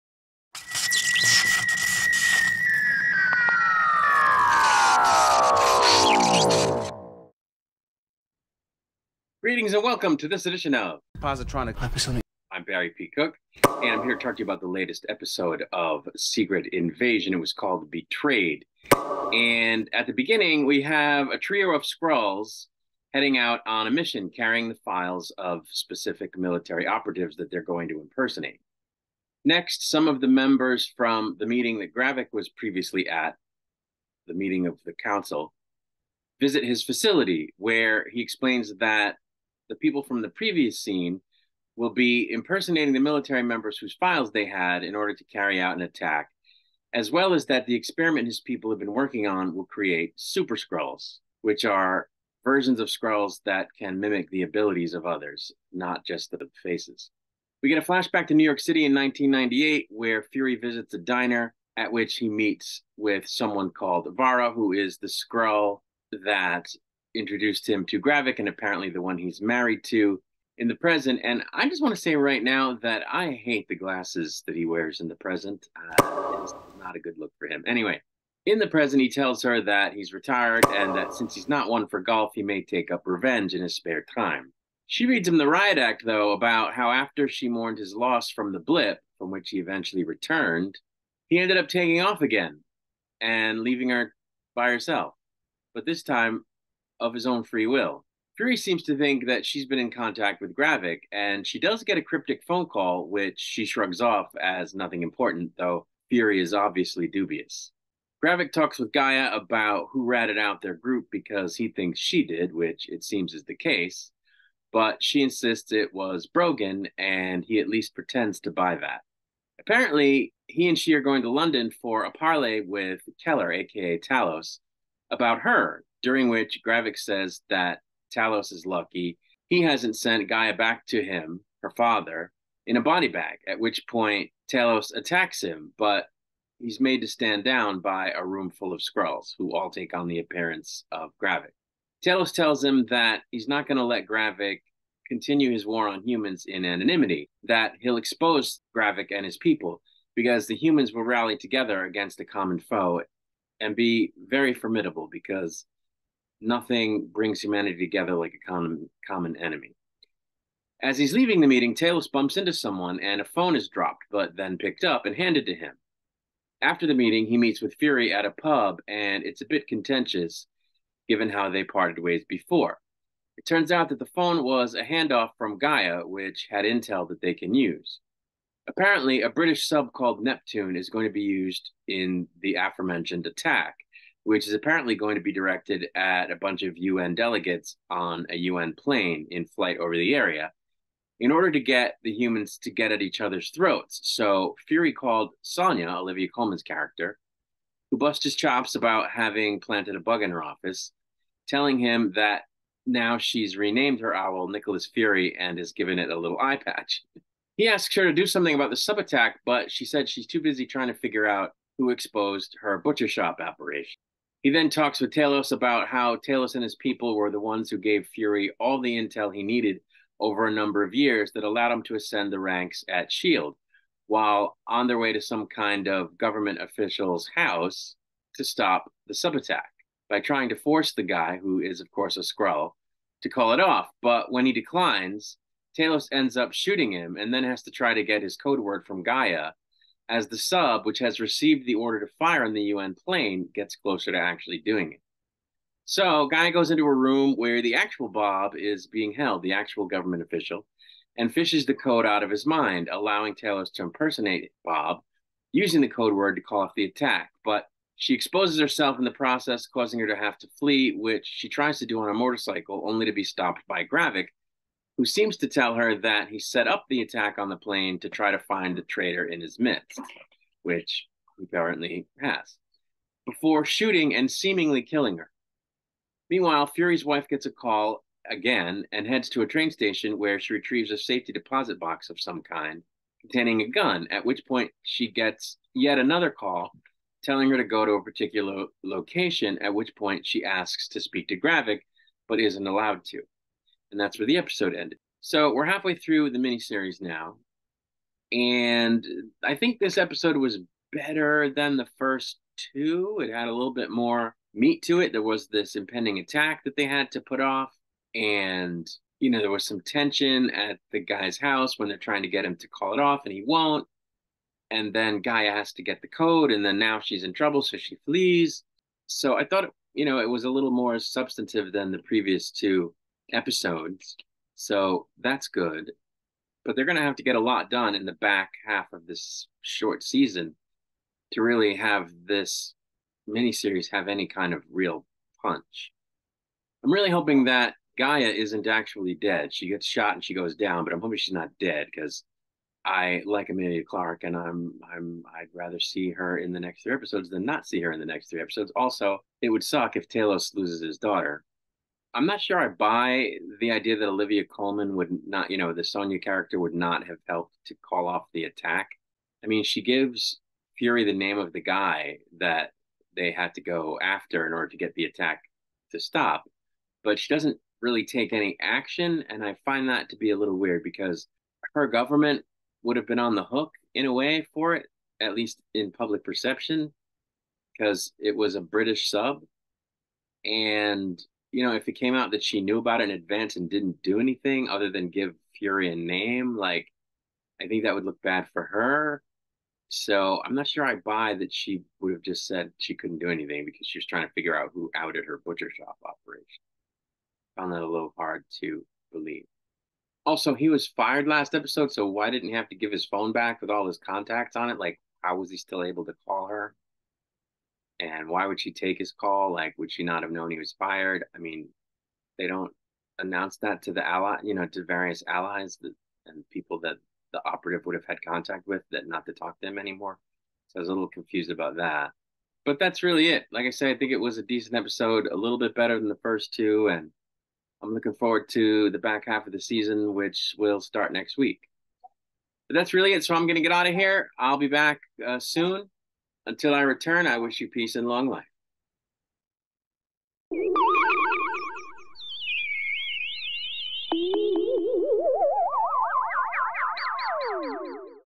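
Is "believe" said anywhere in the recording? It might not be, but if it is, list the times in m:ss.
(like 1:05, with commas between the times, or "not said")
6:39.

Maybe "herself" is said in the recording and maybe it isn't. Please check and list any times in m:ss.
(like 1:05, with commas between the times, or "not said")
1:34, 4:18.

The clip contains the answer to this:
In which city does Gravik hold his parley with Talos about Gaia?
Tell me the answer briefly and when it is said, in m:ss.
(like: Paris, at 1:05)
London, at 2:01.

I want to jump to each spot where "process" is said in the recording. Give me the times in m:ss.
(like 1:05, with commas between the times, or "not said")
4:19.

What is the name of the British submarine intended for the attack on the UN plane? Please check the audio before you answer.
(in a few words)
Neptune.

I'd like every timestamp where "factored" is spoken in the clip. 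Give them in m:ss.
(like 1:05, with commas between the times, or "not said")
not said.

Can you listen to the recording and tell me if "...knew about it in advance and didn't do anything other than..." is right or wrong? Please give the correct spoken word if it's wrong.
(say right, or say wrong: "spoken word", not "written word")
right.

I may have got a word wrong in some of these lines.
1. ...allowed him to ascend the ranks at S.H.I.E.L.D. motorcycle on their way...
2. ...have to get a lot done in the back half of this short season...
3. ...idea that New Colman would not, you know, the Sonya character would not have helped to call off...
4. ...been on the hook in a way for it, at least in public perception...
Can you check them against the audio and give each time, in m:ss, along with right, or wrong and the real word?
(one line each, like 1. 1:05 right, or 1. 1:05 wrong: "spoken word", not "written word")
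1. 3:41 wrong: "while", not "motorcycle"
2. 5:27 right
3. 5:53 wrong: "Olivia", not "New"
4. 6:13 right.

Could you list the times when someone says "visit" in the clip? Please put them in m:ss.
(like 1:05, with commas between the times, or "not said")
0:36, 1:00.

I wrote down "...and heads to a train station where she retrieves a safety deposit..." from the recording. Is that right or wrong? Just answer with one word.
right.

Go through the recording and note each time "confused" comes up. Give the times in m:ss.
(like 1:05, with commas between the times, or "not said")
7:01.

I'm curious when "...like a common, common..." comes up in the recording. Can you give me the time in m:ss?
2:38.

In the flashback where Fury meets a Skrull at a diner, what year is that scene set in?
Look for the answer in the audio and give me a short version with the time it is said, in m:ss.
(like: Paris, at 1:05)
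1998, at 0:58.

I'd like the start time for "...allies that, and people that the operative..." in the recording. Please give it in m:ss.
6:55.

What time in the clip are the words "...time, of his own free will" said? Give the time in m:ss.
1:36.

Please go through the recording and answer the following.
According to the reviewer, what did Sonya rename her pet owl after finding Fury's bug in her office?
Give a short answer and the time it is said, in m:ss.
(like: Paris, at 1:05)
Nicholas Fury, at 3:24.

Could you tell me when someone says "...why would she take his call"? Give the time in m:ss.
6:48.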